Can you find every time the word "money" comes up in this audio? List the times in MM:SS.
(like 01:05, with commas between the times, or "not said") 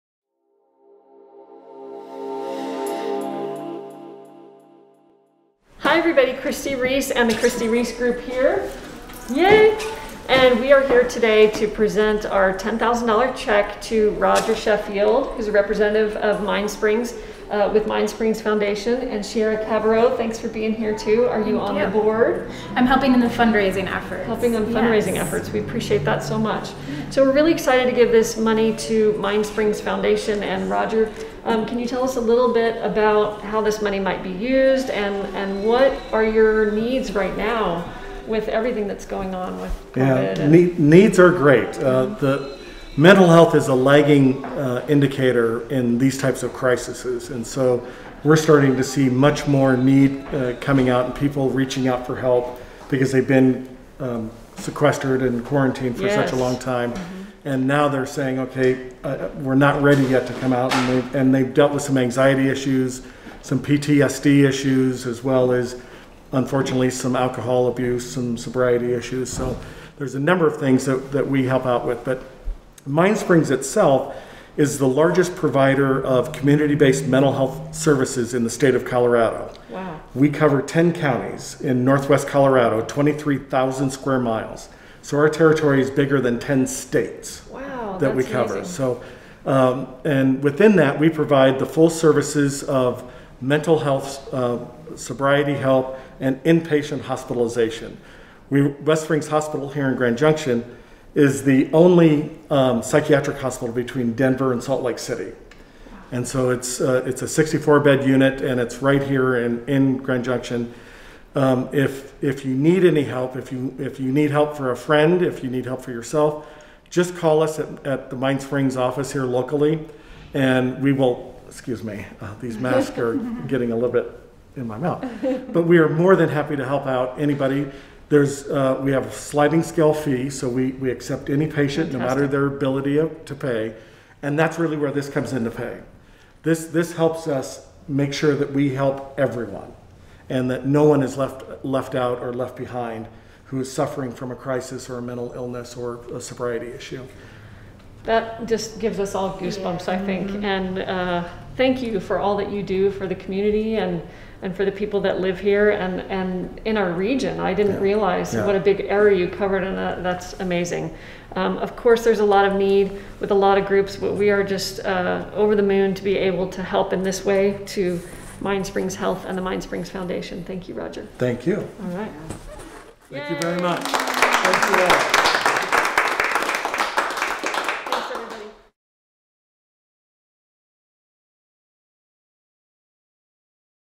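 00:28, 00:33.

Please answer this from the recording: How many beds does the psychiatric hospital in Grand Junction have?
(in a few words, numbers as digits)
64.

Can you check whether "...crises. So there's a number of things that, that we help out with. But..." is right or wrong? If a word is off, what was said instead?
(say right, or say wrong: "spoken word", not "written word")
wrong: "issues", not "crises".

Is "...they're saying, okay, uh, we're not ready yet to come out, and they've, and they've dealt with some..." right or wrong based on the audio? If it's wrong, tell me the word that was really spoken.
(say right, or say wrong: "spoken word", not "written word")
right.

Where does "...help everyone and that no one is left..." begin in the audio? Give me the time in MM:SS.
02:18.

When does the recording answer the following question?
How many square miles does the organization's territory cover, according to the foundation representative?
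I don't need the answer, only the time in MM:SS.
01:22.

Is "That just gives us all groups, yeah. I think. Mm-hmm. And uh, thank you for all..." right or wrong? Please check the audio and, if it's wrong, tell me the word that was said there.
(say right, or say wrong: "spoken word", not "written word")
wrong: "goosebumps", not "groups".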